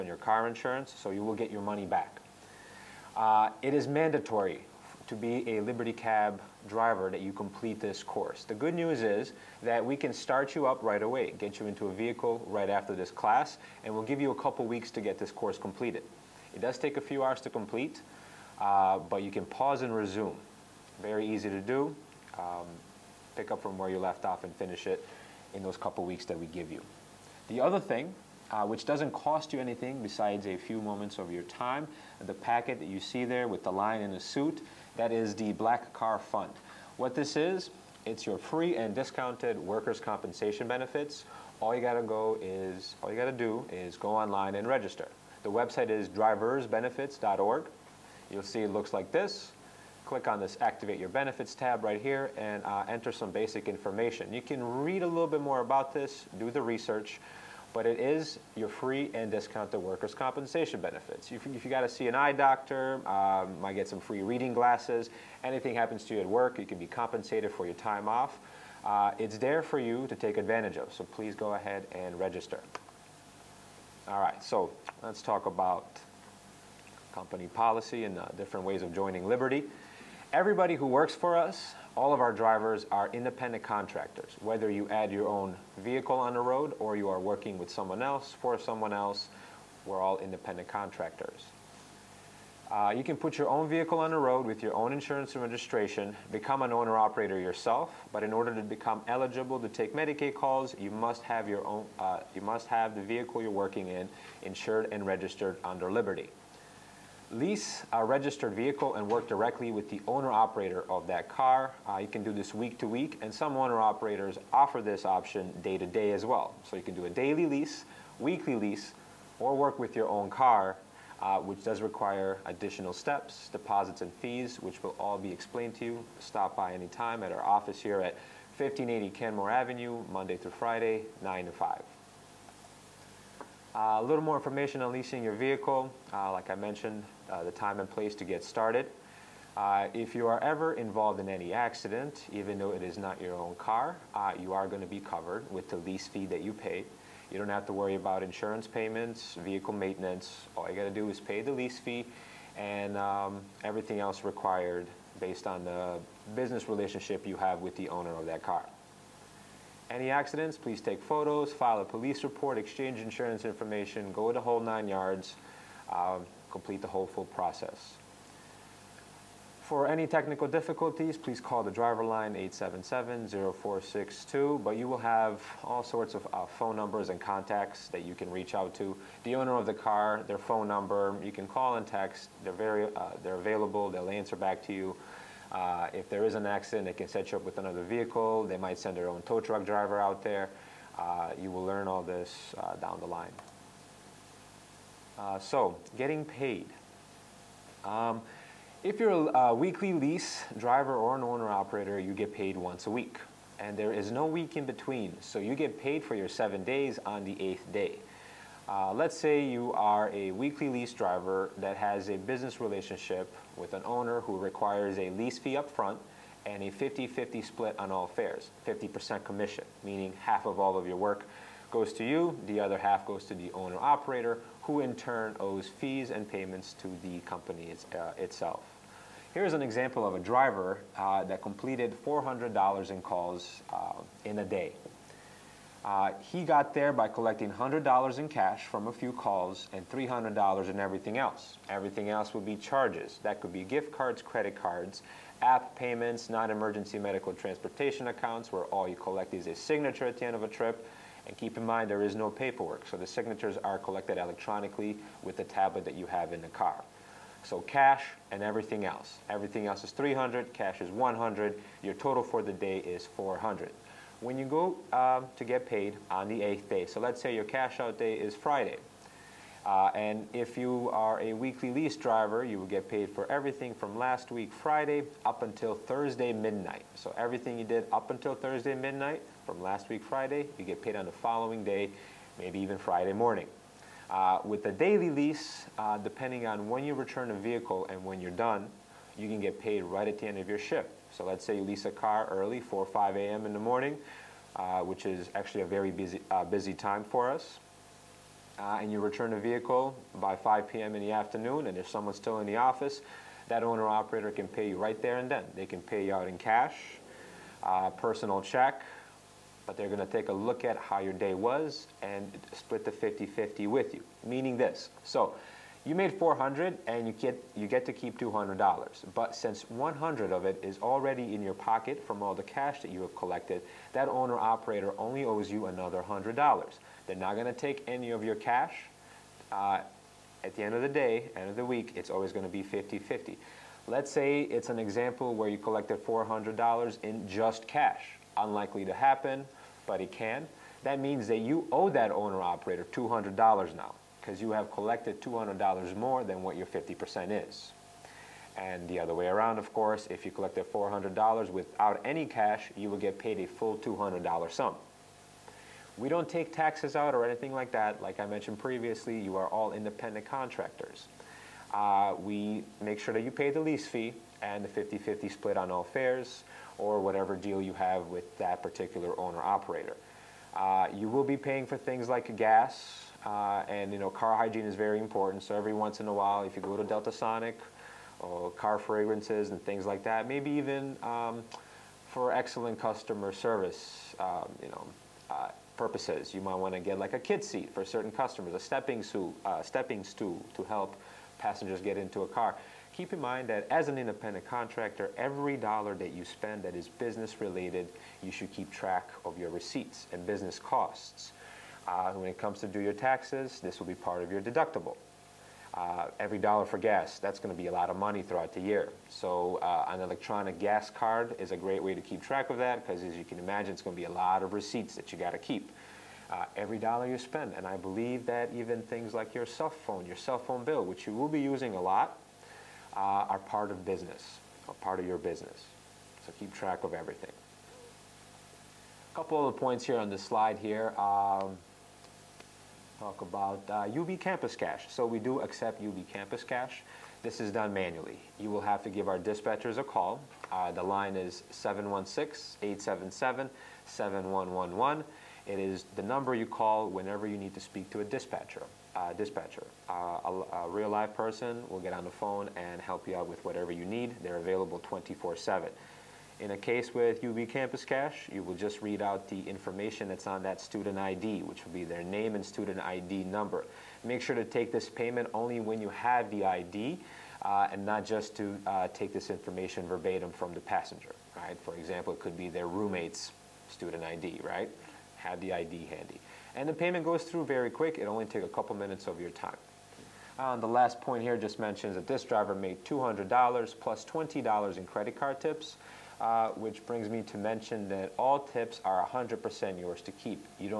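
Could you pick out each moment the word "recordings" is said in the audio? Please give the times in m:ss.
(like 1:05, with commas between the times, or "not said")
not said.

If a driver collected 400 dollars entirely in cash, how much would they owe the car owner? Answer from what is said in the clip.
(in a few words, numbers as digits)
$200.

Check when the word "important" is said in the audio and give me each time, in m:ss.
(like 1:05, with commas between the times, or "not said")
6:14.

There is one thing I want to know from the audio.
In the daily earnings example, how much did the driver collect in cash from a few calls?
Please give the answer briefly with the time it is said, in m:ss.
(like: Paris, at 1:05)
$100, at 3:57.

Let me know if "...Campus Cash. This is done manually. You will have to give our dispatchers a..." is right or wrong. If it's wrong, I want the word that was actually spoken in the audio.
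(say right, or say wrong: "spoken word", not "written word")
right.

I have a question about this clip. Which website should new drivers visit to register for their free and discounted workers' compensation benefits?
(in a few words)
driversbenefits.org.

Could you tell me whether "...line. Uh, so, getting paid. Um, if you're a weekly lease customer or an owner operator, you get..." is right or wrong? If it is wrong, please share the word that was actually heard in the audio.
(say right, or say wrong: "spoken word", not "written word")
wrong: "driver", not "customer".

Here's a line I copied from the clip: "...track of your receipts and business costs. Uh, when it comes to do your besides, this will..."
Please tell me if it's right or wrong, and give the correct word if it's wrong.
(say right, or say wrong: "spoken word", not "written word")
wrong: "taxes", not "besides".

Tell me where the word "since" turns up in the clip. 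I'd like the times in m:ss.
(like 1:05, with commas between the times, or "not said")
5:19.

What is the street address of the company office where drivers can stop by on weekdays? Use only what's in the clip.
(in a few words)
1580 Kenmore Avenue.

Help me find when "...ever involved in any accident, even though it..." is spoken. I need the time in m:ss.
2:20.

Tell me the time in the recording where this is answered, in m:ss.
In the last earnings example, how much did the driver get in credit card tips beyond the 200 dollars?
8:04.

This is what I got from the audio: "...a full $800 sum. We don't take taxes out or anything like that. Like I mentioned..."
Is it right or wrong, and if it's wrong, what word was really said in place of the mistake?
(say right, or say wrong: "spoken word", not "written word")
wrong: "200", not "800".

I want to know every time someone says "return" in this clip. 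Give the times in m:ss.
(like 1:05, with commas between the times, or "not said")
4:46, 4:58.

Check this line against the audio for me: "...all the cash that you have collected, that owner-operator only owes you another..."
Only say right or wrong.
right.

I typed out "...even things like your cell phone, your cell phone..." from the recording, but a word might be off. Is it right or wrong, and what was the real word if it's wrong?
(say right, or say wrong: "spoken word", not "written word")
right.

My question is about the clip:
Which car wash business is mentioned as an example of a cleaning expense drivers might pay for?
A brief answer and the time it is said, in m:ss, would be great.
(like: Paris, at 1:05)
Delta Sonic, at 6:16.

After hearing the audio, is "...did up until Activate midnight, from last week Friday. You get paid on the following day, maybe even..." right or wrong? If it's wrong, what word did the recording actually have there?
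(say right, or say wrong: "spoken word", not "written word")
wrong: "Thursday", not "Activate".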